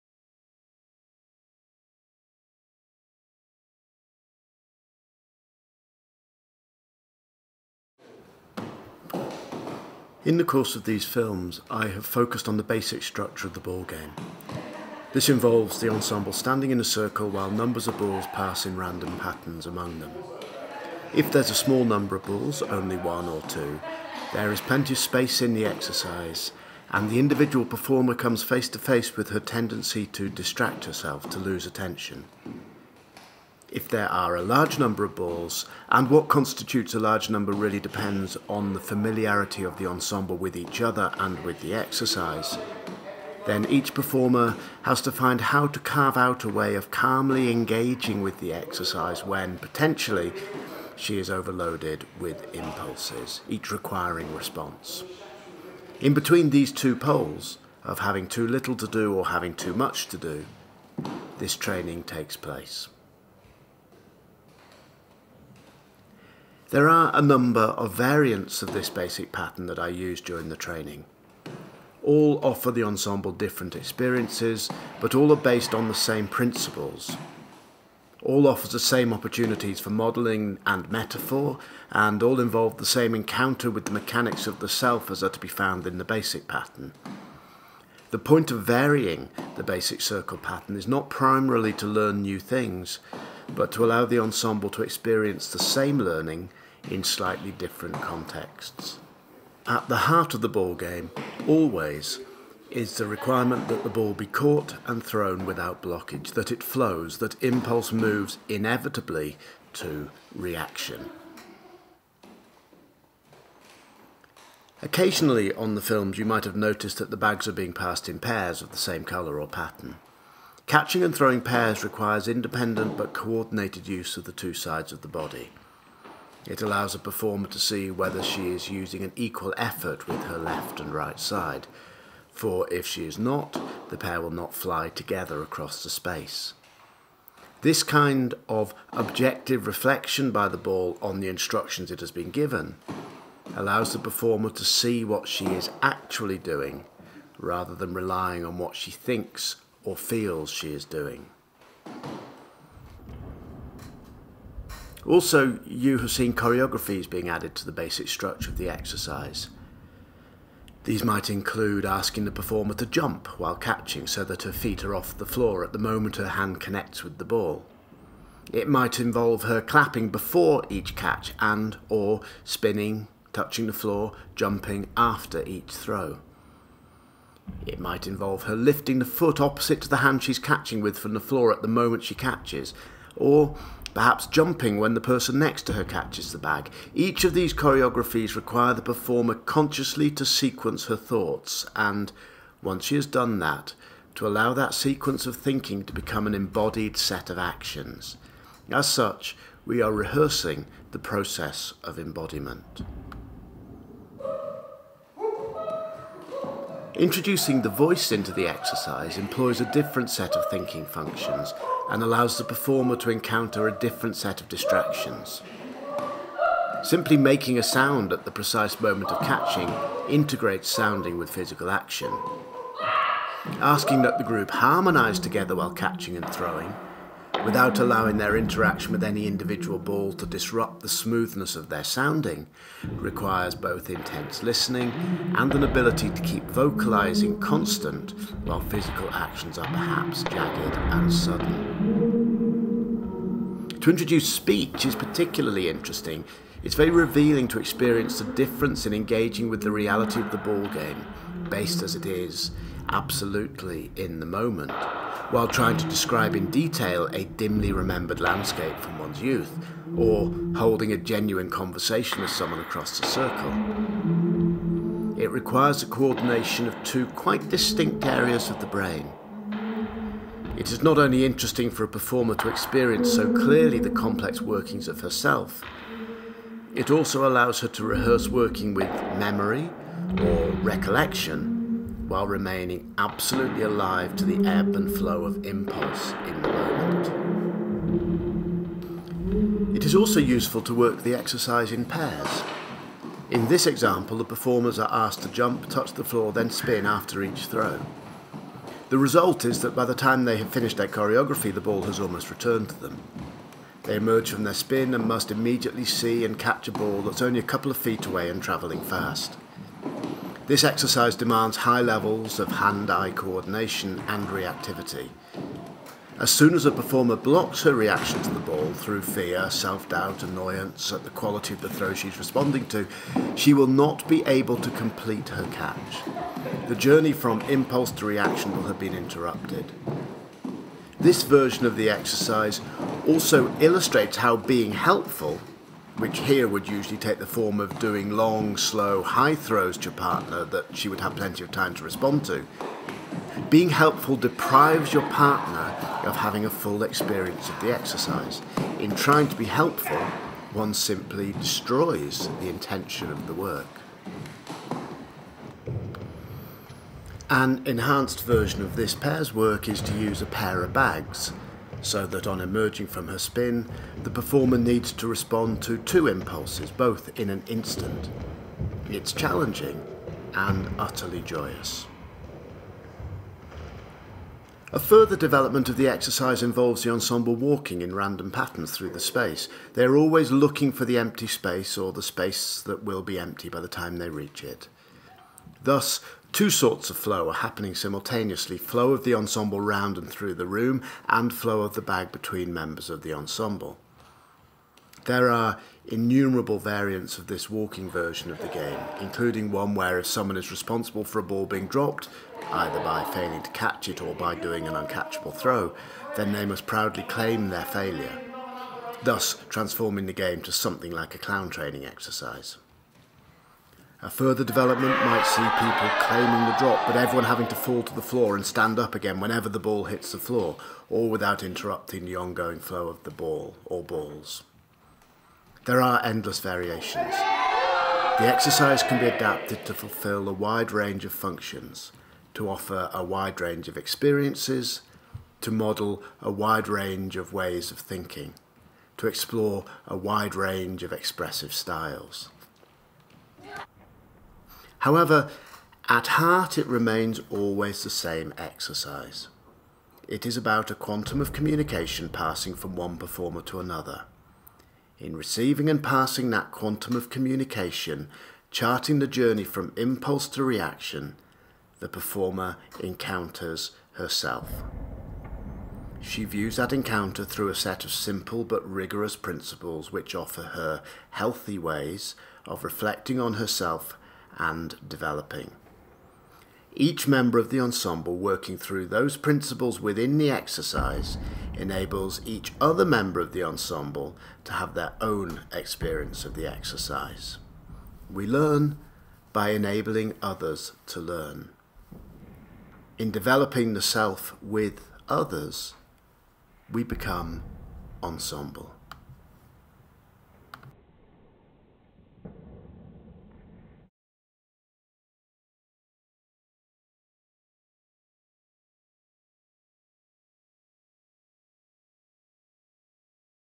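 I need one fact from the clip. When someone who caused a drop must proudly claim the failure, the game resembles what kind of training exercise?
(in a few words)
Clown training.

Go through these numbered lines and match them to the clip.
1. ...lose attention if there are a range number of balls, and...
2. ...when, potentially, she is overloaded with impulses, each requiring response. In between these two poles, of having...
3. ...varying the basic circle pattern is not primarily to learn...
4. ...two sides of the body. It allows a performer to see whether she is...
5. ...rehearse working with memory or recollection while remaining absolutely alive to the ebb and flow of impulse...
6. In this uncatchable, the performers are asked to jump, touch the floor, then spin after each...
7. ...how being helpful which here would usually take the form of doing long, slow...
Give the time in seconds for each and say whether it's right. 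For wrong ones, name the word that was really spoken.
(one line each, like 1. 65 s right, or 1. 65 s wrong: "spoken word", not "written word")
1. 31 s wrong: "large", not "range"
2. 49 s right
3. 88 s right
4. 124 s right
5. 277 s right
6. 293 s wrong: "example", not "uncatchable"
7. 334 s right.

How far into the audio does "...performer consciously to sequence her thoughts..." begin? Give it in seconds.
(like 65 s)
188 s.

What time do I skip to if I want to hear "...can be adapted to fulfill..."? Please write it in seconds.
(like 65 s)
428 s.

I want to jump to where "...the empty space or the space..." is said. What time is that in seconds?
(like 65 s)
380 s.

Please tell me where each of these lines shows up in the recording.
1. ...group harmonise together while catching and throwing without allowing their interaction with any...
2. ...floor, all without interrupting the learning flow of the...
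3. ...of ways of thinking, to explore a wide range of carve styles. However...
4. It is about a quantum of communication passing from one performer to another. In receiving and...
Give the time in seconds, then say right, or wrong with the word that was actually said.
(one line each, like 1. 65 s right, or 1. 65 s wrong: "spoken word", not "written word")
1. 224 s right
2. 420 s wrong: "ongoing", not "learning"
3. 437 s wrong: "expressive", not "carve"
4. 450 s right.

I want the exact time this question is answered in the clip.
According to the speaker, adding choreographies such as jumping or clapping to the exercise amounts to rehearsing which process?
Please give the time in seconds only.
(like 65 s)
200 s.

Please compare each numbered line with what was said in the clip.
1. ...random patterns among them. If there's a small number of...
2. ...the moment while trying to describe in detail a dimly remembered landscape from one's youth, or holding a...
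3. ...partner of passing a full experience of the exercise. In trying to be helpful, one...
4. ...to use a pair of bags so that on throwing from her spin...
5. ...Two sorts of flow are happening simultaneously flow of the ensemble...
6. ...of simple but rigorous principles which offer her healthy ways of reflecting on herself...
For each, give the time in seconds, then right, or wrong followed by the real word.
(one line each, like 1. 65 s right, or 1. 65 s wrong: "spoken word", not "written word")
1. 18 s right
2. 254 s right
3. 345 s wrong: "having", not "passing"
4. 359 s wrong: "emerging", not "throwing"
5. 386 s right
6. 467 s right.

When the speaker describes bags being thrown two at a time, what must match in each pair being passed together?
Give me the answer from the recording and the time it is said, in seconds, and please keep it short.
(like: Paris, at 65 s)
Colour or pattern, at 119 s.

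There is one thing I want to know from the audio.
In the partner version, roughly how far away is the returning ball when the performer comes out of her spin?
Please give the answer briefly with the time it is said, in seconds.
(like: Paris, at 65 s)
A couple of feet, at 307 s.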